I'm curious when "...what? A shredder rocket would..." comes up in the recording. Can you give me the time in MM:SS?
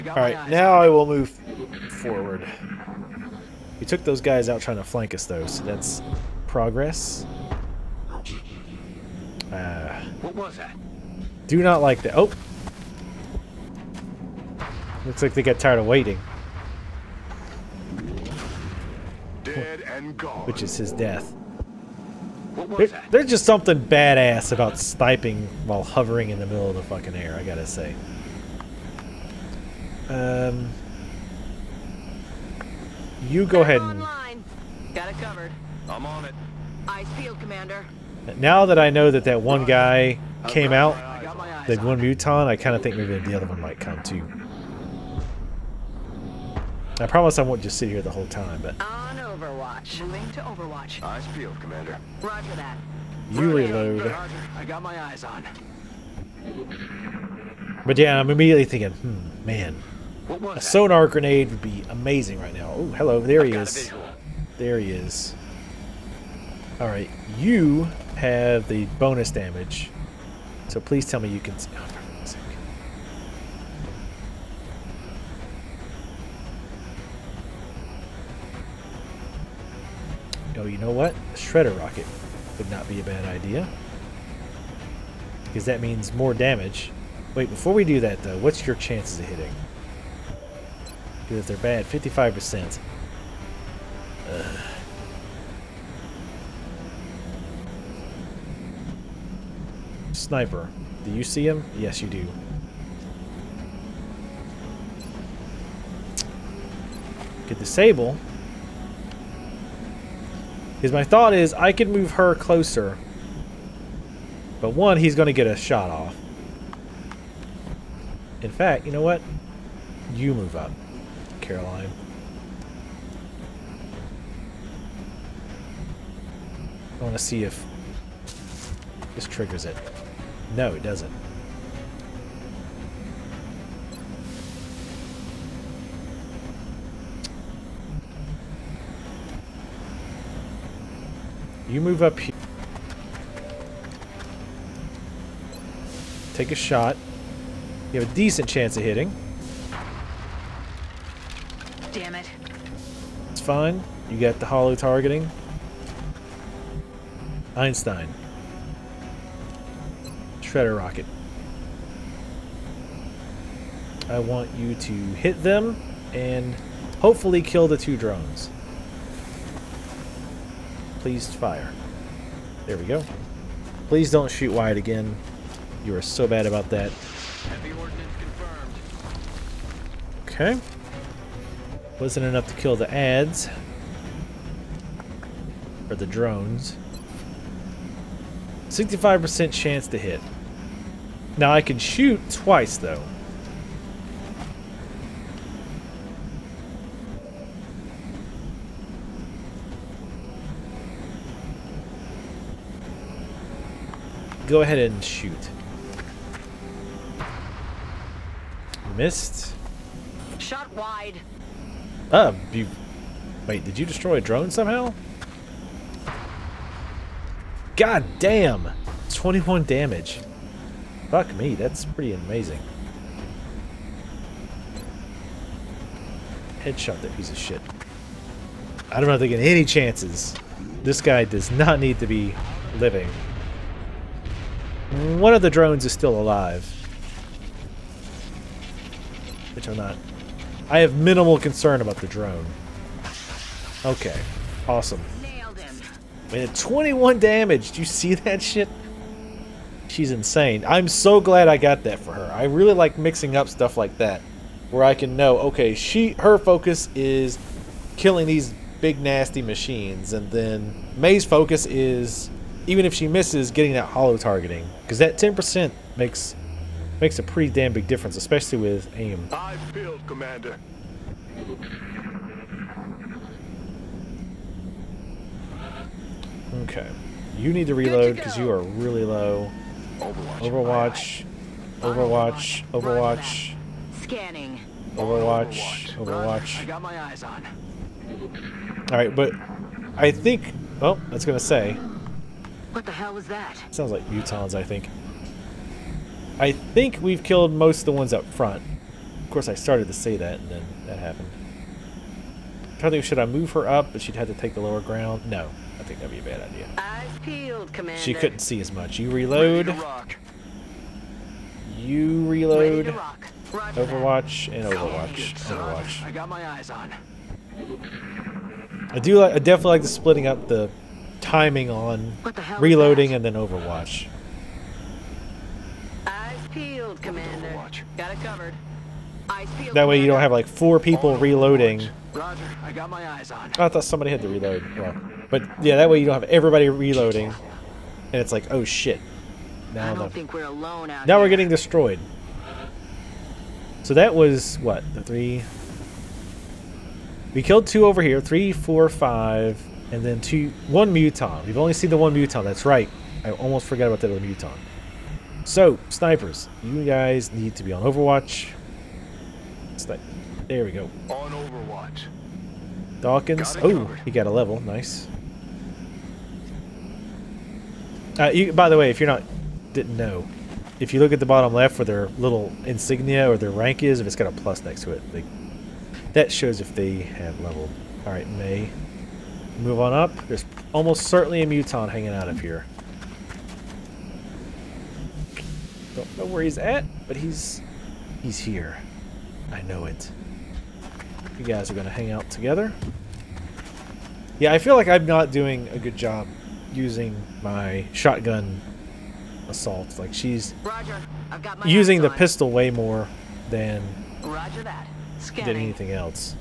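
01:20.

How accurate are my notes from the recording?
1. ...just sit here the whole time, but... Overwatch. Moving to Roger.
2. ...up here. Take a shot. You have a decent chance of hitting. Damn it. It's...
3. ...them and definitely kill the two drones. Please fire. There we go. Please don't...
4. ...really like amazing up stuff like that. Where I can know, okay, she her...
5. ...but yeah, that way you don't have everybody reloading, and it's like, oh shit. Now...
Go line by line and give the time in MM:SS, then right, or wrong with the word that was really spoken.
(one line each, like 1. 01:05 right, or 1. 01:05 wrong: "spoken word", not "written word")
1. 00:47 wrong: "Overwatch", not "Roger"
2. 02:22 right
3. 02:45 wrong: "hopefully", not "definitely"
4. 04:12 wrong: "mixing", not "amazing"
5. 05:35 right.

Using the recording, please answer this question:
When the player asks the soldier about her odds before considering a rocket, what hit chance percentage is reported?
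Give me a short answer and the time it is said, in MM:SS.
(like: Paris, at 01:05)
55%, at 01:31.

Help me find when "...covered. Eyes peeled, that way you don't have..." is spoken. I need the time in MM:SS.
05:28.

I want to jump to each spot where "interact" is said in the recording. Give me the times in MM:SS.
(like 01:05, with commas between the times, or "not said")
not said.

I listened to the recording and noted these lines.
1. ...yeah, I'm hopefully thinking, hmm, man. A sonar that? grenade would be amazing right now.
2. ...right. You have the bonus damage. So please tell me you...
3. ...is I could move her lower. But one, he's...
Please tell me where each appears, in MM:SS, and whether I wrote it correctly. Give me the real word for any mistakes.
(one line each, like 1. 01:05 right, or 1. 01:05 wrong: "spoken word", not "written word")
1. 00:57 wrong: "immediately", not "hopefully"
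2. 01:06 right
3. 01:51 wrong: "closer", not "lower".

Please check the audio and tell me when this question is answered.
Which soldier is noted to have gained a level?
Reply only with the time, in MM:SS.
06:03.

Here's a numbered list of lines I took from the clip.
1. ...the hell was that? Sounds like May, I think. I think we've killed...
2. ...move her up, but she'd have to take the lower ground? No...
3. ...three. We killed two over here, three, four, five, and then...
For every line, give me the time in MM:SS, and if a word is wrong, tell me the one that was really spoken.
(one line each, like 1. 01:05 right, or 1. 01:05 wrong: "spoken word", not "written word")
1. 04:52 wrong: "Mutons", not "May"
2. 05:03 right
3. 05:45 right.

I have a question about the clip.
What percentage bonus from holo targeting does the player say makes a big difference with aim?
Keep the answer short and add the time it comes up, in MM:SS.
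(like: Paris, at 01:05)
10%, at 04:25.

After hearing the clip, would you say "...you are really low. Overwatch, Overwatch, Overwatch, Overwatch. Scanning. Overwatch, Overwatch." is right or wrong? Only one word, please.
right.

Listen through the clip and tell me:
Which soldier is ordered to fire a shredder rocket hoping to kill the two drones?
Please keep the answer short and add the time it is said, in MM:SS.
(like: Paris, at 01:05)
Einstein, at 02:37.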